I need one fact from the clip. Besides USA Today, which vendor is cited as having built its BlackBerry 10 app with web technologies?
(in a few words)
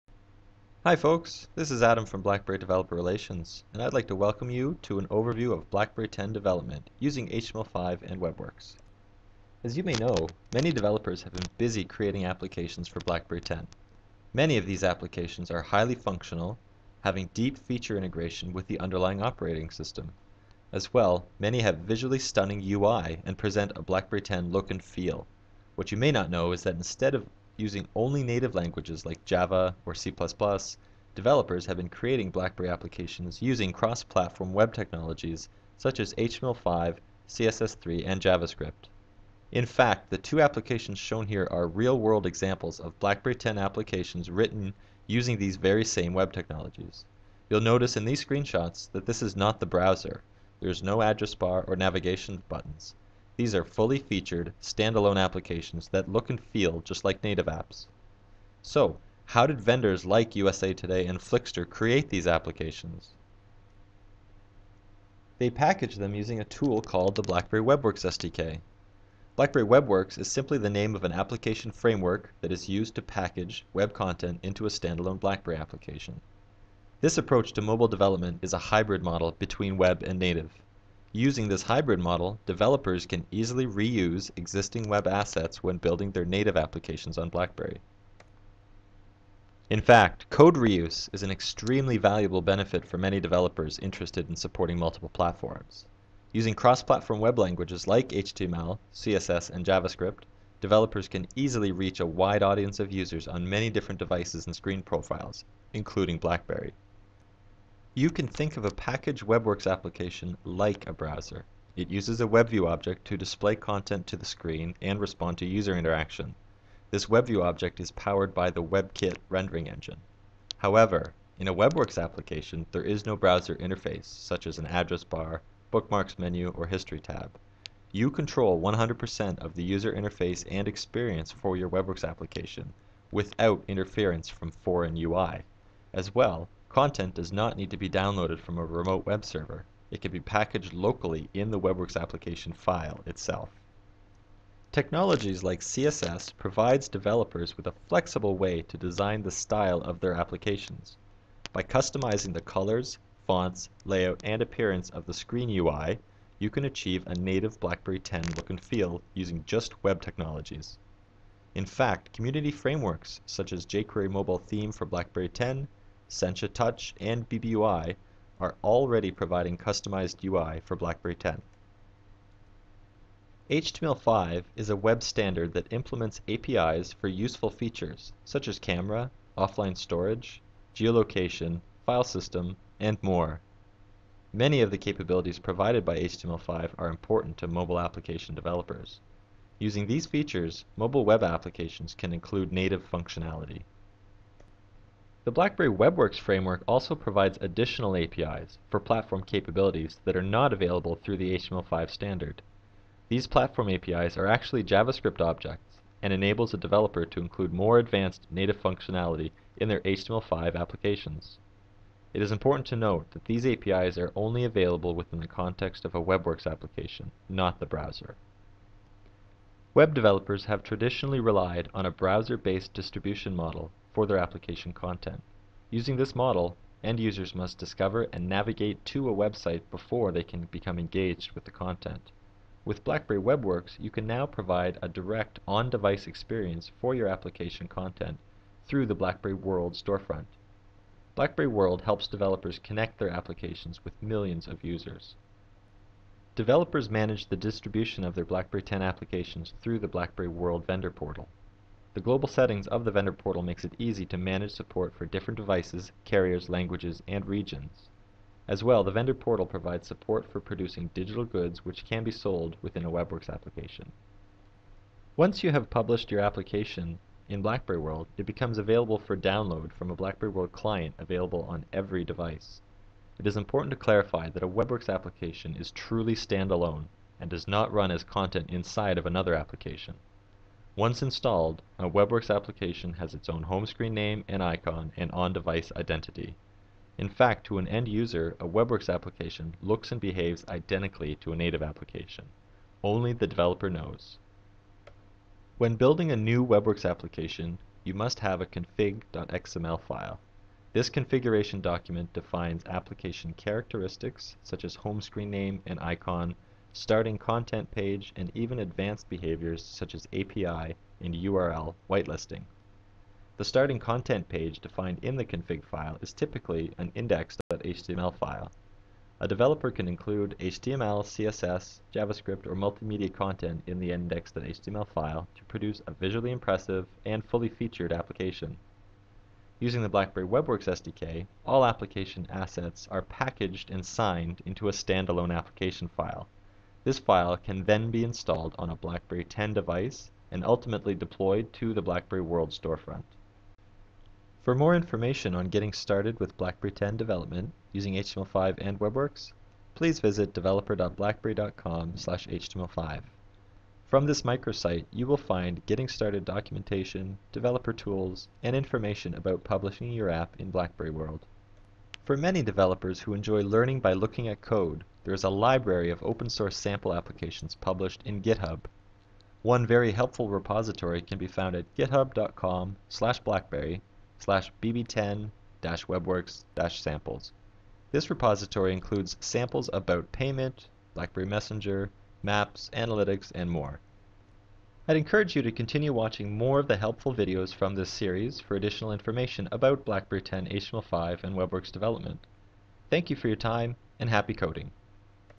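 Flixster.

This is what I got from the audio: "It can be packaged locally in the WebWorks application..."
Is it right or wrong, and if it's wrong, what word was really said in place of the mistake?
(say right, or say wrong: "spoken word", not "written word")
right.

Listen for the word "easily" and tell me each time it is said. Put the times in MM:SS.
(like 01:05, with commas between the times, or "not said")
01:23, 01:41.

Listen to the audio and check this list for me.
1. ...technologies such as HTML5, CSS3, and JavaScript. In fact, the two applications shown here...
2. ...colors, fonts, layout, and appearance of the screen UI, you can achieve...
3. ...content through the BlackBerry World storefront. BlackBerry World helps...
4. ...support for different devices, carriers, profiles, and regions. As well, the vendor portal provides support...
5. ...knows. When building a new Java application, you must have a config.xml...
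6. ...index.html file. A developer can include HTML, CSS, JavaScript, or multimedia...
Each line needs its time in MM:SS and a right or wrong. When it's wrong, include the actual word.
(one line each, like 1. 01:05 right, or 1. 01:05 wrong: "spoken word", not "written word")
1. 00:34 right
2. 02:32 right
3. 03:57 right
4. 04:14 wrong: "languages", not "profiles"
5. 04:53 wrong: "WebWorks", not "Java"
6. 05:16 right.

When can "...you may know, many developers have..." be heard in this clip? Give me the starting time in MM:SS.
00:09.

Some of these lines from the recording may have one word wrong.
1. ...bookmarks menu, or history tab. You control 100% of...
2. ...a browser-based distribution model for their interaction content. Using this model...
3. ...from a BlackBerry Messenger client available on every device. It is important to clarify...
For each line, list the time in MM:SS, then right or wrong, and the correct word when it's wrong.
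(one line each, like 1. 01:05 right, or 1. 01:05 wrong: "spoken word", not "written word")
1. 02:05 right
2. 03:41 wrong: "application", not "interaction"
3. 04:29 wrong: "World", not "Messenger".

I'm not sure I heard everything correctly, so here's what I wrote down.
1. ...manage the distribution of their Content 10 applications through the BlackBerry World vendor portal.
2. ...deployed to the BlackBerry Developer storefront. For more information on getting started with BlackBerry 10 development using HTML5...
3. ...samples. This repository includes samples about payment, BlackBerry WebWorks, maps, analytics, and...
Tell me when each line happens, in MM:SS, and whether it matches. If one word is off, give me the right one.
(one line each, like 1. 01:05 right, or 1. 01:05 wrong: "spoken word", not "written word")
1. 04:06 wrong: "BlackBerry", not "Content"
2. 05:40 wrong: "World", not "Developer"
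3. 06:16 wrong: "Messenger", not "WebWorks".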